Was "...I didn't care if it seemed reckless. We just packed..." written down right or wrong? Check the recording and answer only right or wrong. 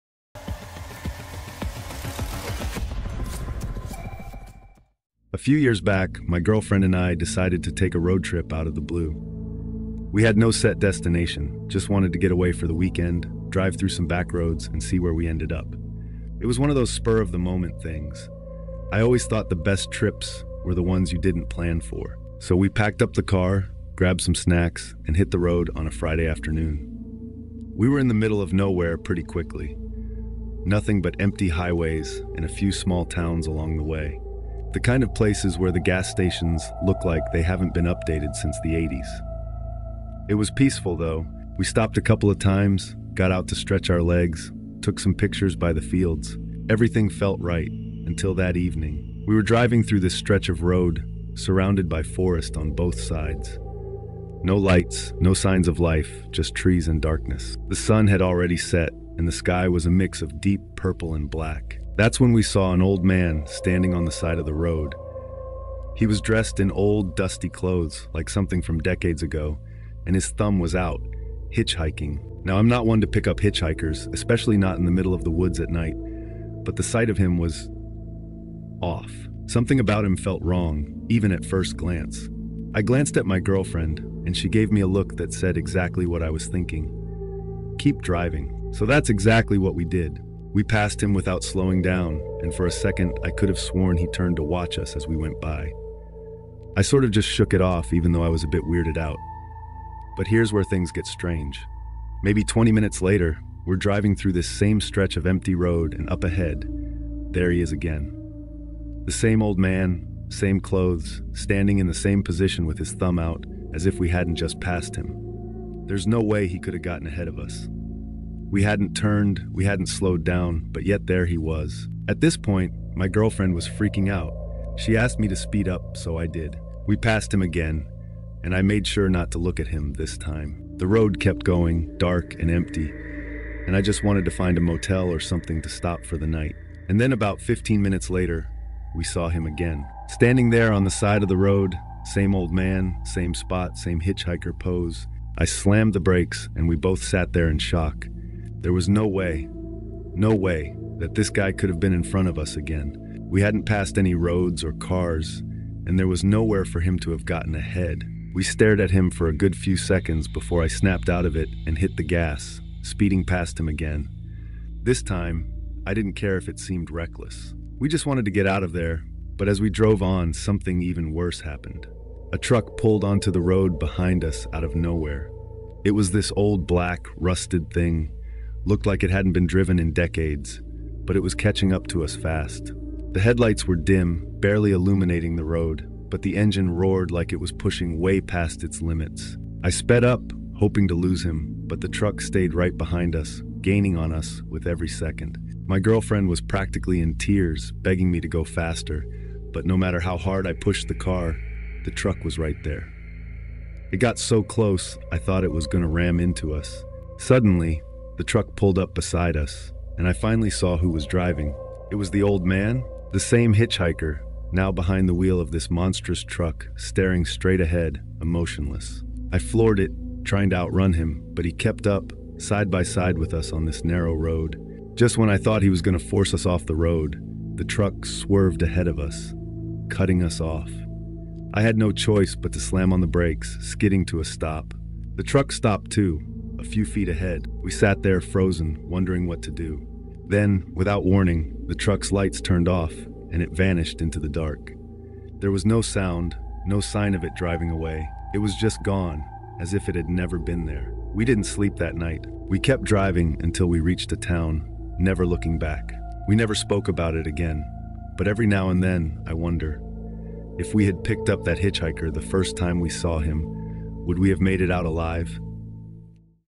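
wrong.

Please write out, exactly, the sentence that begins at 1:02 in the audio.
That's when we saw an old man standing on the side of the road.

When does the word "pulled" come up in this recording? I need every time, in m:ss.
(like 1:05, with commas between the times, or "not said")
2:52, 3:28.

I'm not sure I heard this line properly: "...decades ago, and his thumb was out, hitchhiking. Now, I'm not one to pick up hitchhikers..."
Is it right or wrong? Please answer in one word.
right.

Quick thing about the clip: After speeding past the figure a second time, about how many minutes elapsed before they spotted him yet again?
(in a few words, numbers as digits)
15.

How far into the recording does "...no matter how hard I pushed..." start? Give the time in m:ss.
3:19.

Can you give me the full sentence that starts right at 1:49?
The same old man, same clothes, standing in the same position with his thumb out, as if we hadn't just passed him.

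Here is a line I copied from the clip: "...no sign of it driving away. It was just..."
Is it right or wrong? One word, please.
right.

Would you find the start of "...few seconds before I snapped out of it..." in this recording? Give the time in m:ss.
2:39.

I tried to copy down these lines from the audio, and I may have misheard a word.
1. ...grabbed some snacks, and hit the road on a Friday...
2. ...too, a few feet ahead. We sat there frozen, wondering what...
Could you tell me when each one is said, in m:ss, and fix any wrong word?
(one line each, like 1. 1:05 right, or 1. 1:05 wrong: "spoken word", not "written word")
1. 0:23 right
2. 3:55 right.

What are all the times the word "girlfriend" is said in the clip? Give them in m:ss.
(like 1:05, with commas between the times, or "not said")
0:06, 1:23, 2:03, 3:15.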